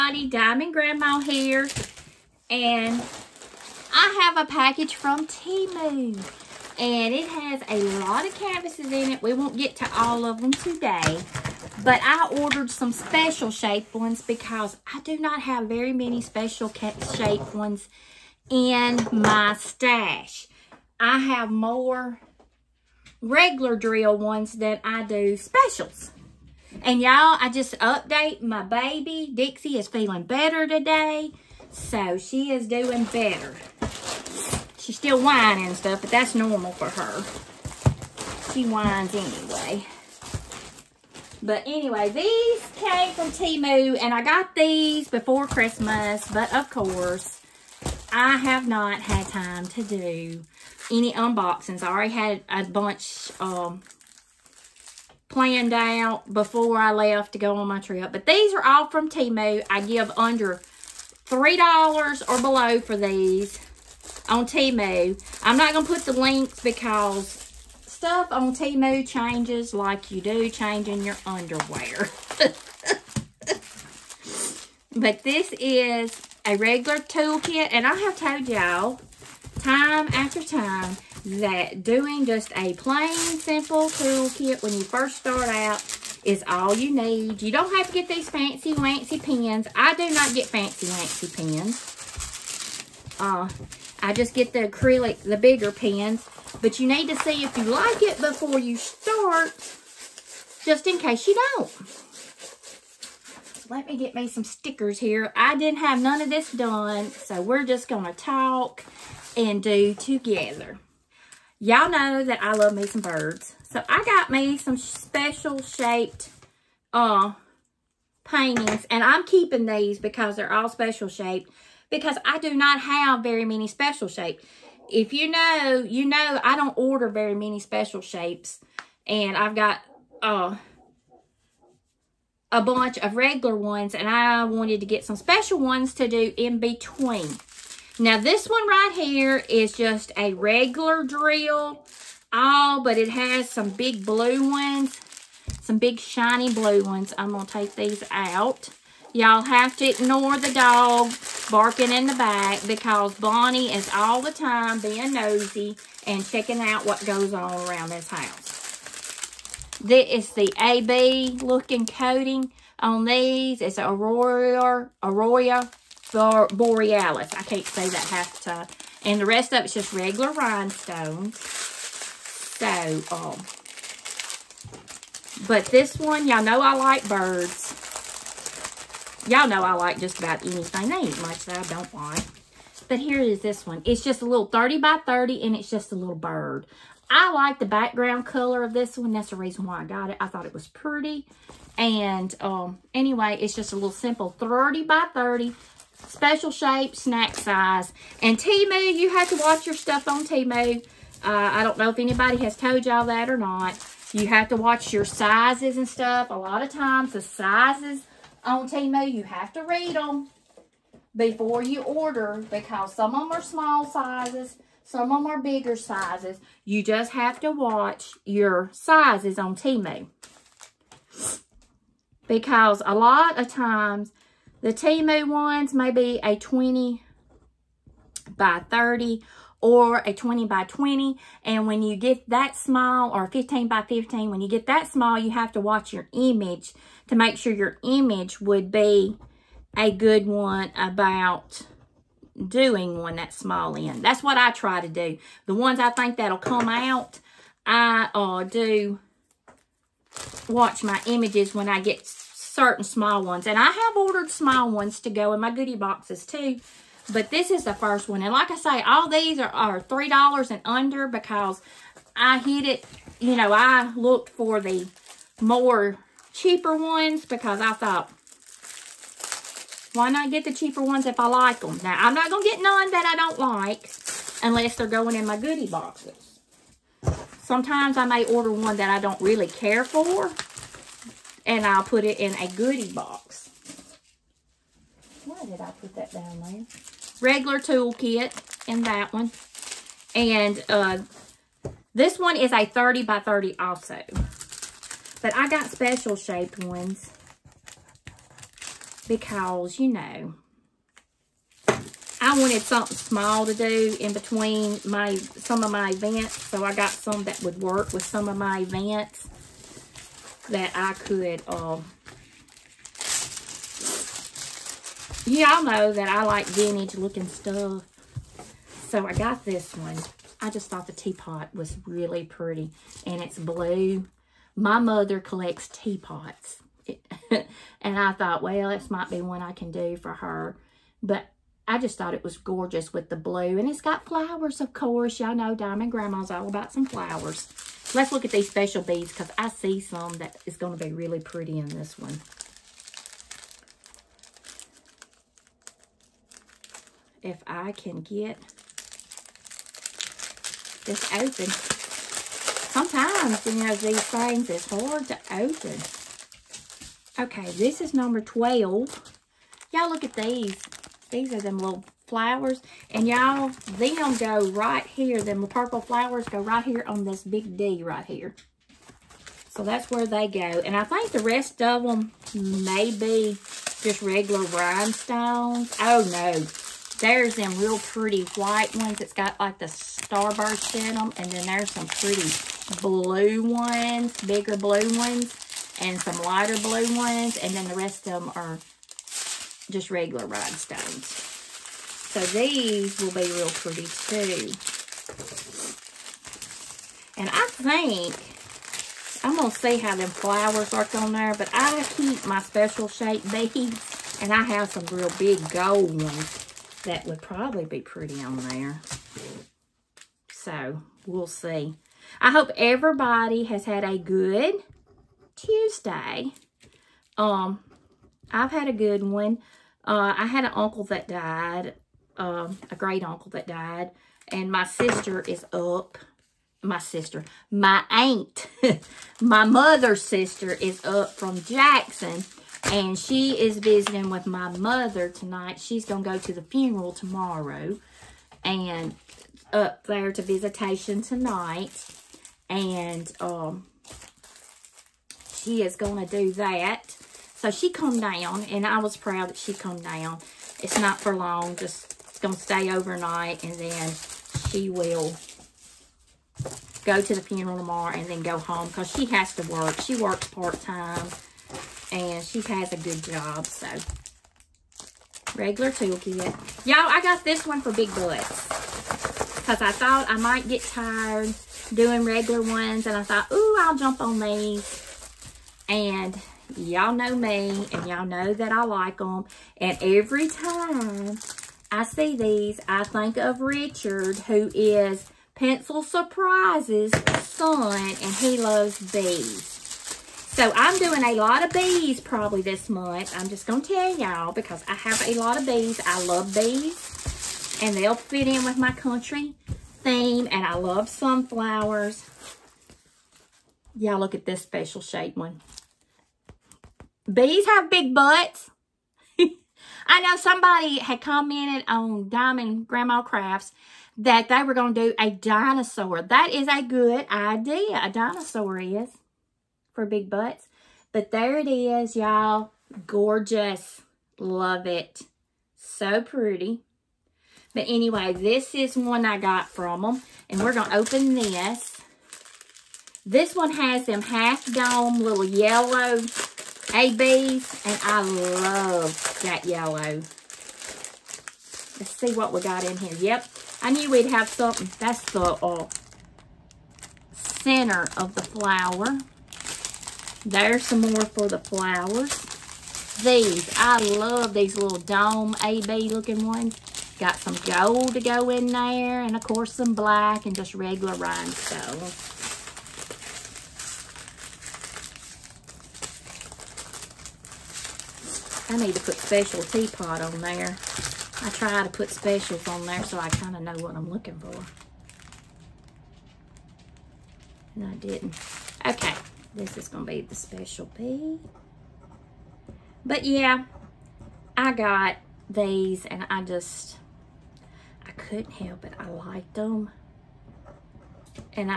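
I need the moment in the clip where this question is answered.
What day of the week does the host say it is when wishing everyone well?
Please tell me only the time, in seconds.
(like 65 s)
415 s.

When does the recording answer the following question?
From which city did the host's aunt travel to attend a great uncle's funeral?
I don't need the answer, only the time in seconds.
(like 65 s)
431 s.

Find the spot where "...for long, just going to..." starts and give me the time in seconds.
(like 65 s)
450 s.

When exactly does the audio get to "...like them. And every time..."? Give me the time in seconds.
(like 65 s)
478 s.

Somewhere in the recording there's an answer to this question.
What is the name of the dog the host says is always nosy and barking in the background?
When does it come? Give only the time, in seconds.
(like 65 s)
153 s.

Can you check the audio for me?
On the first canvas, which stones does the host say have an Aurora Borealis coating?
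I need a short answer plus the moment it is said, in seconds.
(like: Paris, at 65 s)
big shiny blue ones, at 145 s.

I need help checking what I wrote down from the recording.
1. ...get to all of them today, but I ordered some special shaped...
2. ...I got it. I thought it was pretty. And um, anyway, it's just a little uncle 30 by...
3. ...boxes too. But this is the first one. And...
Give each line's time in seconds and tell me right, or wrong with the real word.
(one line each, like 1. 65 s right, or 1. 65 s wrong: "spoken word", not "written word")
1. 9 s right
2. 189 s wrong: "simple", not "uncle"
3. 255 s right.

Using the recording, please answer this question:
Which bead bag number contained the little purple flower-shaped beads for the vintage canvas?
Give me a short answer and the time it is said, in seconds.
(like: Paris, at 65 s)
12, at 357 s.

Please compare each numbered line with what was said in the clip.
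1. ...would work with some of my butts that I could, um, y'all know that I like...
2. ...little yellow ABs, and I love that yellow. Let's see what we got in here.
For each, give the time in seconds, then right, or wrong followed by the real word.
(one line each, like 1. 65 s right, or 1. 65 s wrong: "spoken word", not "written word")
1. 307 s wrong: "events", not "butts"
2. 534 s right.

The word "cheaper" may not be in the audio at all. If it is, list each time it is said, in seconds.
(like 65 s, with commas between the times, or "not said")
266 s, 270 s.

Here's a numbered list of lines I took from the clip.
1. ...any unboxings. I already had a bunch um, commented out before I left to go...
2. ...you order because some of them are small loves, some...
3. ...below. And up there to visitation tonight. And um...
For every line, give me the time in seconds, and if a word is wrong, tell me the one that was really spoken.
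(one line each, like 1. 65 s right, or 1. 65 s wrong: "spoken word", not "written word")
1. 50 s wrong: "planned", not "commented"
2. 211 s wrong: "sizes", not "loves"
3. 436 s wrong: "tomorrow", not "below".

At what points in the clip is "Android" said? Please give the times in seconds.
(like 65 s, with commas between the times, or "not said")
not said.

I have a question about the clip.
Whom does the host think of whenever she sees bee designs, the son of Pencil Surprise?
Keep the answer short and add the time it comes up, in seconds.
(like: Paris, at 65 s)
Richard, at 483 s.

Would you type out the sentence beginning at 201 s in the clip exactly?
Uh, I don't know if anybody has told y'all that or not.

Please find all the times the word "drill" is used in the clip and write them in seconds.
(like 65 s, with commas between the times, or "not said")
23 s, 141 s.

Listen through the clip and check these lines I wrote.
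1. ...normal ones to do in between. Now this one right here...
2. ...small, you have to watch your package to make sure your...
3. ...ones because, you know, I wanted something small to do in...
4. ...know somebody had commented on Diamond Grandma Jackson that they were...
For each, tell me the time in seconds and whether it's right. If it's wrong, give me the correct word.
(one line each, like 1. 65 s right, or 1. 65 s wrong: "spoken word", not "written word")
1. 135 s wrong: "special", not "normal"
2. 234 s wrong: "image", not "package"
3. 296 s right
4. 509 s wrong: "Crafts", not "Jackson".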